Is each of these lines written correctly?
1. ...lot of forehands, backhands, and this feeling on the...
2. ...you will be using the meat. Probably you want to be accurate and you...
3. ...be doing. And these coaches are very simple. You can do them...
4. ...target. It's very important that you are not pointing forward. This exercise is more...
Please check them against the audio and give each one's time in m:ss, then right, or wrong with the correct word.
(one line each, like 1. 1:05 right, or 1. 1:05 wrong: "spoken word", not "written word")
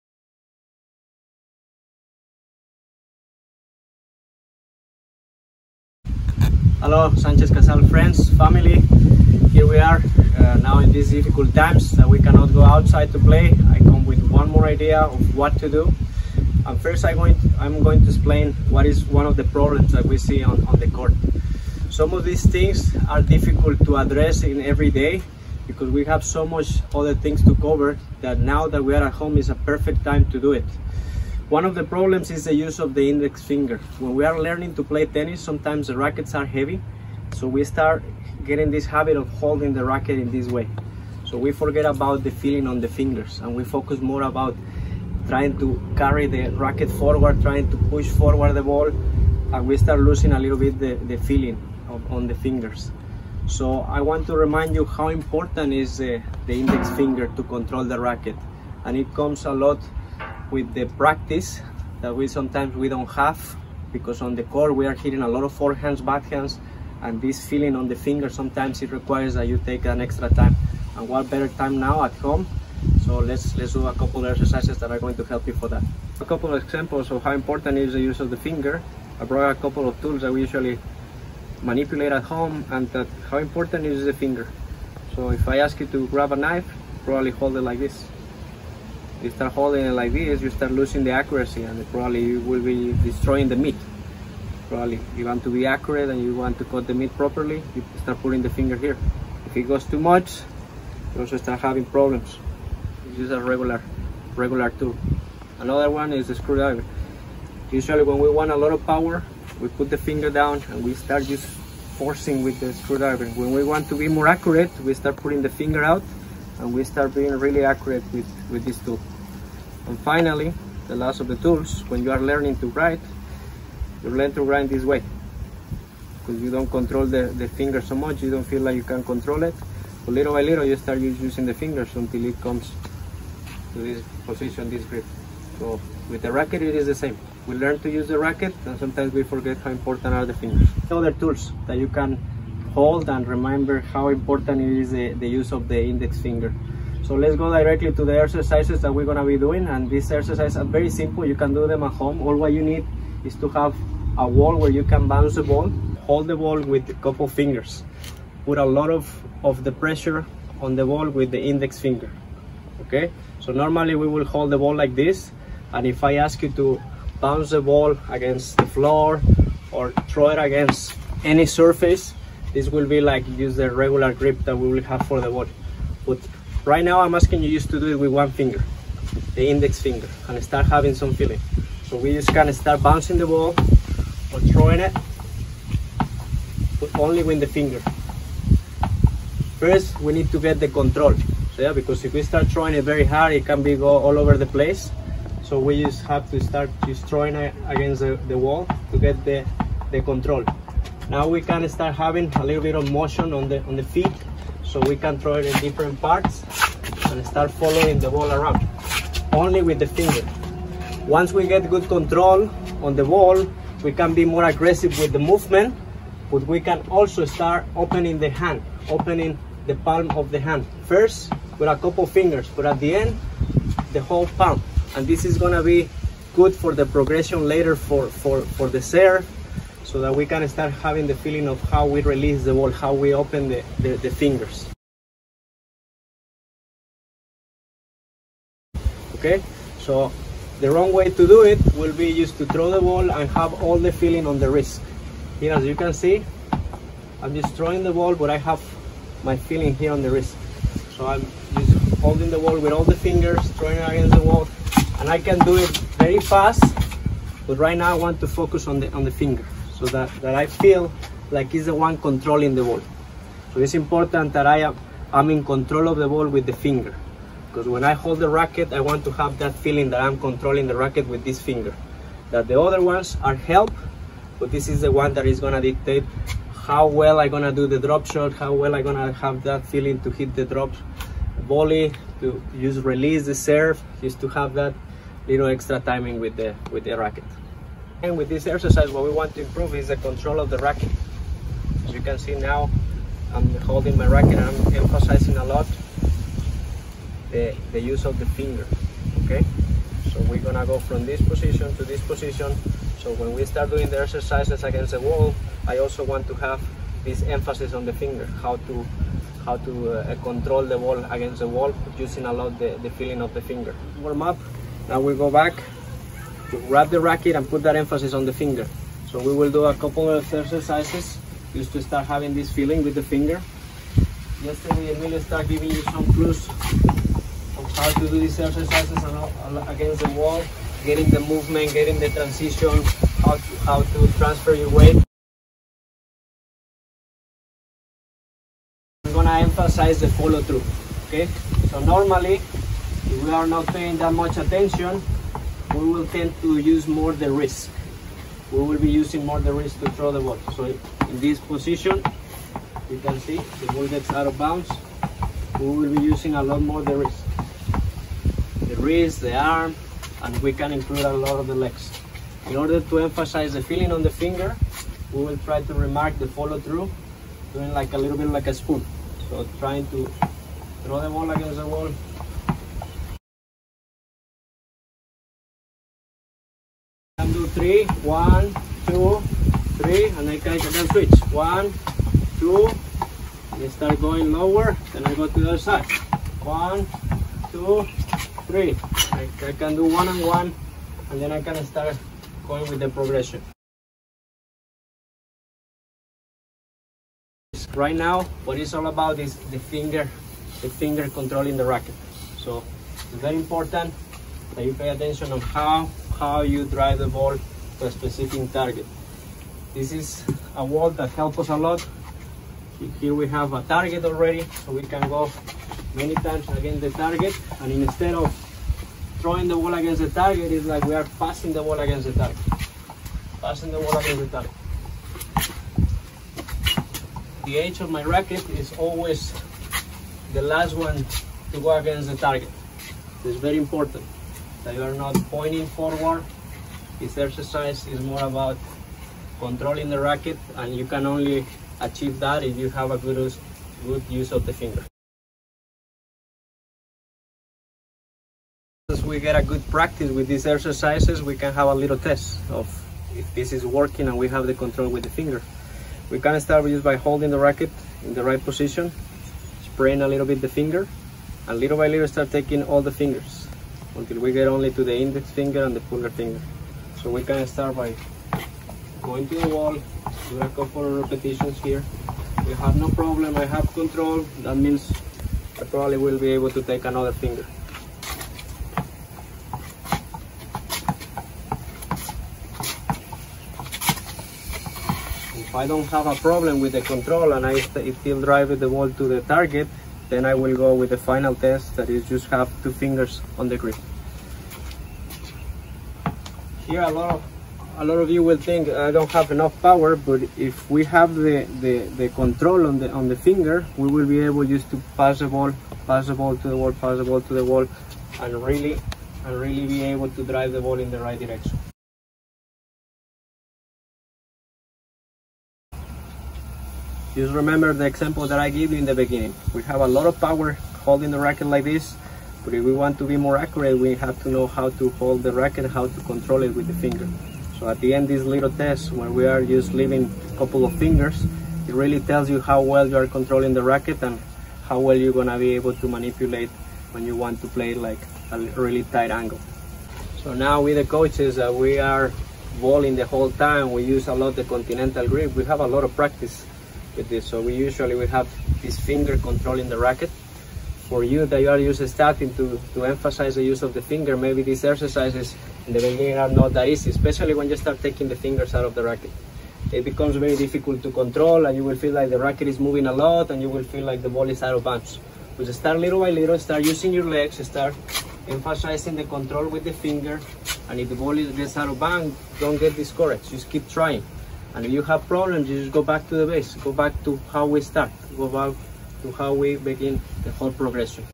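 1. 1:05 right
2. 1:32 wrong: "destroying", not "using"
3. 2:29 wrong: "exercises", not "coaches"
4. 7:12 right.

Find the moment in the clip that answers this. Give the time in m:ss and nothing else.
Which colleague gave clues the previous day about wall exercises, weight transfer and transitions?
5:24.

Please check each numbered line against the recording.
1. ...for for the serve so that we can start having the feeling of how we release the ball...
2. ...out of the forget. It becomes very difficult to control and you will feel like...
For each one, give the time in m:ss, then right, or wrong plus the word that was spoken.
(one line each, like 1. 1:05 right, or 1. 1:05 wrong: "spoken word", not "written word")
1. 3:48 right
2. 9:18 wrong: "racket", not "forget".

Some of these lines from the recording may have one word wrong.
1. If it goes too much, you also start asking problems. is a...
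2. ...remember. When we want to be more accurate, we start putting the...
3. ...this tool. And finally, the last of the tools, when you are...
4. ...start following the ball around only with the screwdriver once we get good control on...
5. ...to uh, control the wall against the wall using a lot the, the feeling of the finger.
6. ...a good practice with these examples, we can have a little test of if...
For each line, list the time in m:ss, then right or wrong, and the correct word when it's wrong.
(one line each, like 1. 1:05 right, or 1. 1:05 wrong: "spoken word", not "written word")
1. 1:39 wrong: "having", not "asking"
2. 1:52 wrong: "screwdriver", not "remember"
3. 1:58 right
4. 3:27 wrong: "finger", not "screwdriver"
5. 5:09 right
6. 7:29 wrong: "exercises", not "examples".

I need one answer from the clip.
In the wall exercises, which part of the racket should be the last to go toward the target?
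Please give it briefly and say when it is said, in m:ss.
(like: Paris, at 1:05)
The edge, at 7:07.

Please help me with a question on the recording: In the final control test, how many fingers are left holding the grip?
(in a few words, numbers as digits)
2.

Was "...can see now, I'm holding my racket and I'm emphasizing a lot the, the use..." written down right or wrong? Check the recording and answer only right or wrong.
right.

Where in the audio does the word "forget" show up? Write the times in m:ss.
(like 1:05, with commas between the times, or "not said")
0:41, 2:19.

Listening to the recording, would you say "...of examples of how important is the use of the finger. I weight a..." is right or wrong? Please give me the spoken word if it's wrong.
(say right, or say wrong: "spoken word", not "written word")
wrong: "brought", not "weight".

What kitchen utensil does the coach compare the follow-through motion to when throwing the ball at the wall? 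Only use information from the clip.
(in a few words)
A spoon.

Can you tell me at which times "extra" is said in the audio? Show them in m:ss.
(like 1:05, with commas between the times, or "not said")
1:10, 4:45.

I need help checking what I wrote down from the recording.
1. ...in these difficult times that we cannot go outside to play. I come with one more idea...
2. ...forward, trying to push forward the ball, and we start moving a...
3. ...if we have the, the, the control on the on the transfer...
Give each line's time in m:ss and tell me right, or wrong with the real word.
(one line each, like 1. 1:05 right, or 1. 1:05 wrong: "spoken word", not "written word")
1. 0:10 right
2. 0:46 wrong: "losing", not "moving"
3. 8:20 wrong: "finger", not "transfer".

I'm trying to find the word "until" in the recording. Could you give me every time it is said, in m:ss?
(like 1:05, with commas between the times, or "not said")
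2:11, 7:43.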